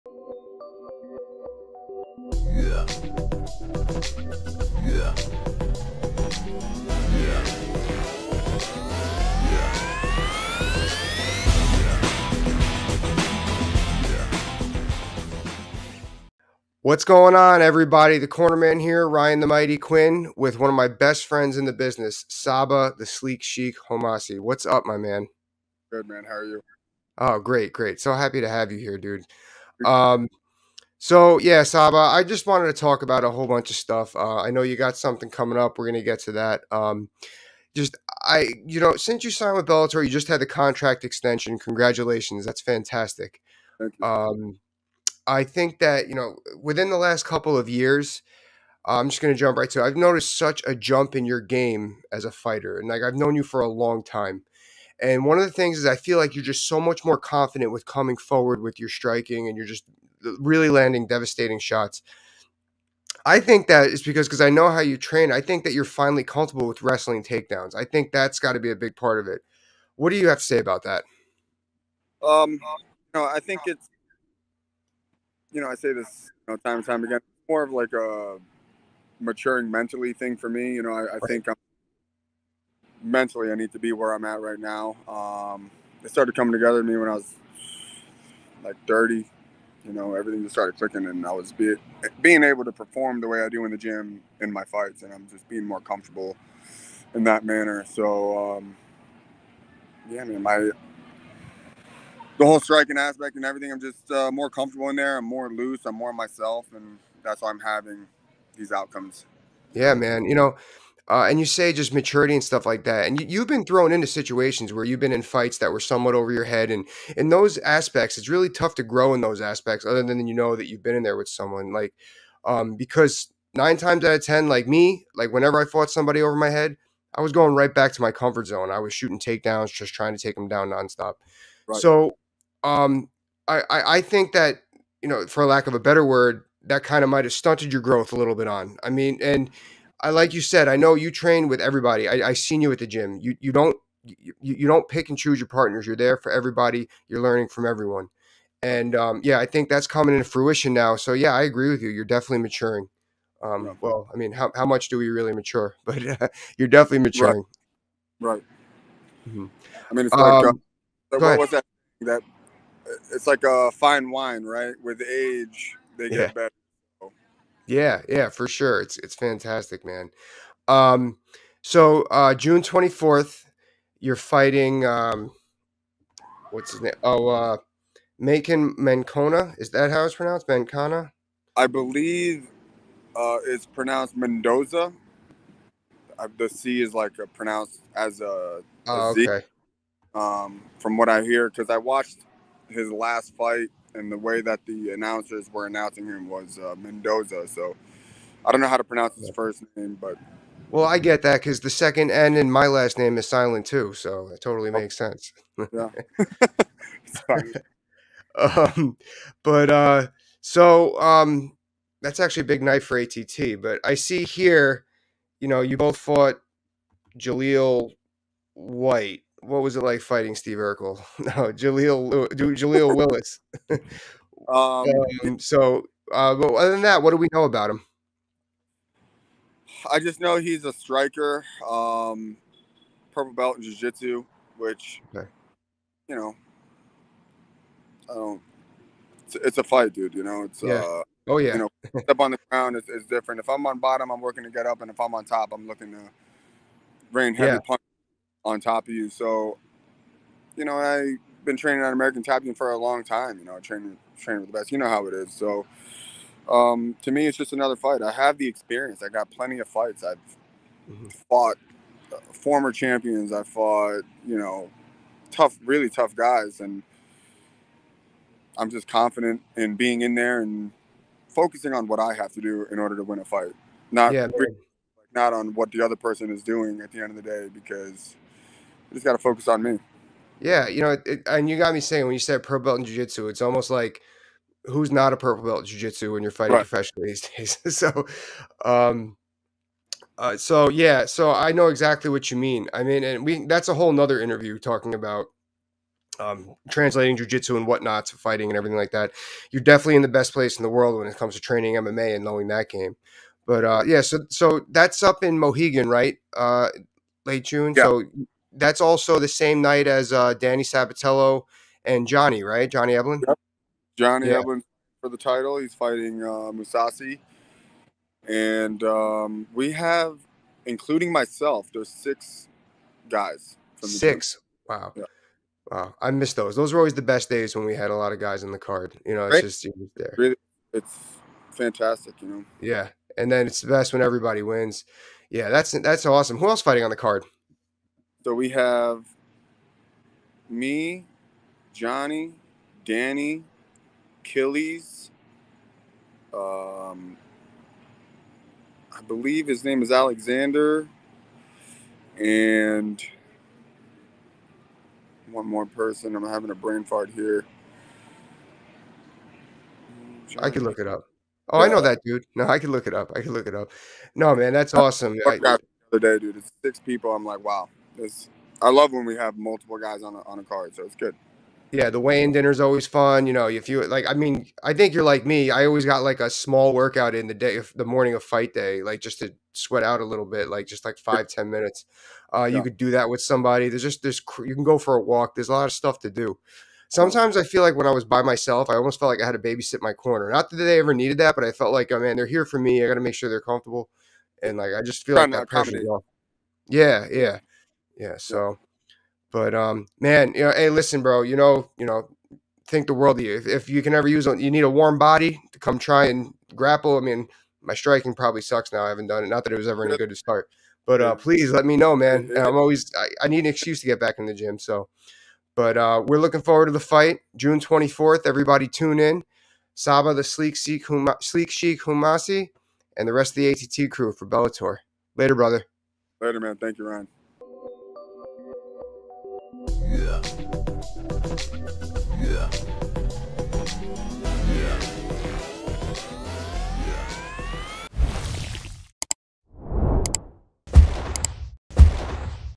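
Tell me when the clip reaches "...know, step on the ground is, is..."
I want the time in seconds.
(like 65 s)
241 s.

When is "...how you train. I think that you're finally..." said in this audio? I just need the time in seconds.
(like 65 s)
64 s.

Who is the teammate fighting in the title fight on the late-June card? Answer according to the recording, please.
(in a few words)
Mousasi.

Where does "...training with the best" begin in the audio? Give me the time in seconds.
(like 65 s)
254 s.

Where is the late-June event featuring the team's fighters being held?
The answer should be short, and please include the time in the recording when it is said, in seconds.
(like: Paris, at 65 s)
Mohegan, at 305 s.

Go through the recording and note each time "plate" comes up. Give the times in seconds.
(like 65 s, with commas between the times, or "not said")
not said.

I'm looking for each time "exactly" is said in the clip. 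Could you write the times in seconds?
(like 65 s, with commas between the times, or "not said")
291 s.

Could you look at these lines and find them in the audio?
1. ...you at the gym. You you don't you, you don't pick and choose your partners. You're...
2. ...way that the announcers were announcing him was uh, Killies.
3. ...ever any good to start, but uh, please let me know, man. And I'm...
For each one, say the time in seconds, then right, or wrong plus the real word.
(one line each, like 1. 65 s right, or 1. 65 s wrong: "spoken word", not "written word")
1. 142 s right
2. 194 s wrong: "Mendoza", not "Killies"
3. 409 s right.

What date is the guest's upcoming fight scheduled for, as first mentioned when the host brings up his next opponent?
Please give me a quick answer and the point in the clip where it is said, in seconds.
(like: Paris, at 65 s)
June 24th, at 172 s.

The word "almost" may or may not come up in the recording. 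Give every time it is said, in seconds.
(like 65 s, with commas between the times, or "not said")
283 s, 388 s.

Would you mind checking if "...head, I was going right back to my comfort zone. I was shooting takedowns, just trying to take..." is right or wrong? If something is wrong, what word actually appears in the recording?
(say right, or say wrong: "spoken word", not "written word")
right.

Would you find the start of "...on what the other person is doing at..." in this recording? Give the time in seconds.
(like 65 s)
275 s.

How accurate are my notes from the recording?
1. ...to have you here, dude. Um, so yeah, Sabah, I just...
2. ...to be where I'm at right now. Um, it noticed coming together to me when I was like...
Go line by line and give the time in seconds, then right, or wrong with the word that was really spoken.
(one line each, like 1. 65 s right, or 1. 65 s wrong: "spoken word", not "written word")
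1. 28 s right
2. 83 s wrong: "started", not "noticed".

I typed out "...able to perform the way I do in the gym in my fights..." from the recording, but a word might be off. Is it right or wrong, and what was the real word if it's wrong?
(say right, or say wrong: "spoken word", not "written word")
right.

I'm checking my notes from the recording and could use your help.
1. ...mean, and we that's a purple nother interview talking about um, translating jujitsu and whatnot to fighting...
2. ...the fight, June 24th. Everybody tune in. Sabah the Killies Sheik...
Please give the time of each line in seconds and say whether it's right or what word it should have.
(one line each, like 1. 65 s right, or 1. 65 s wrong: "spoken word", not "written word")
1. 292 s wrong: "whole", not "purple"
2. 416 s wrong: "Sleek", not "Killies".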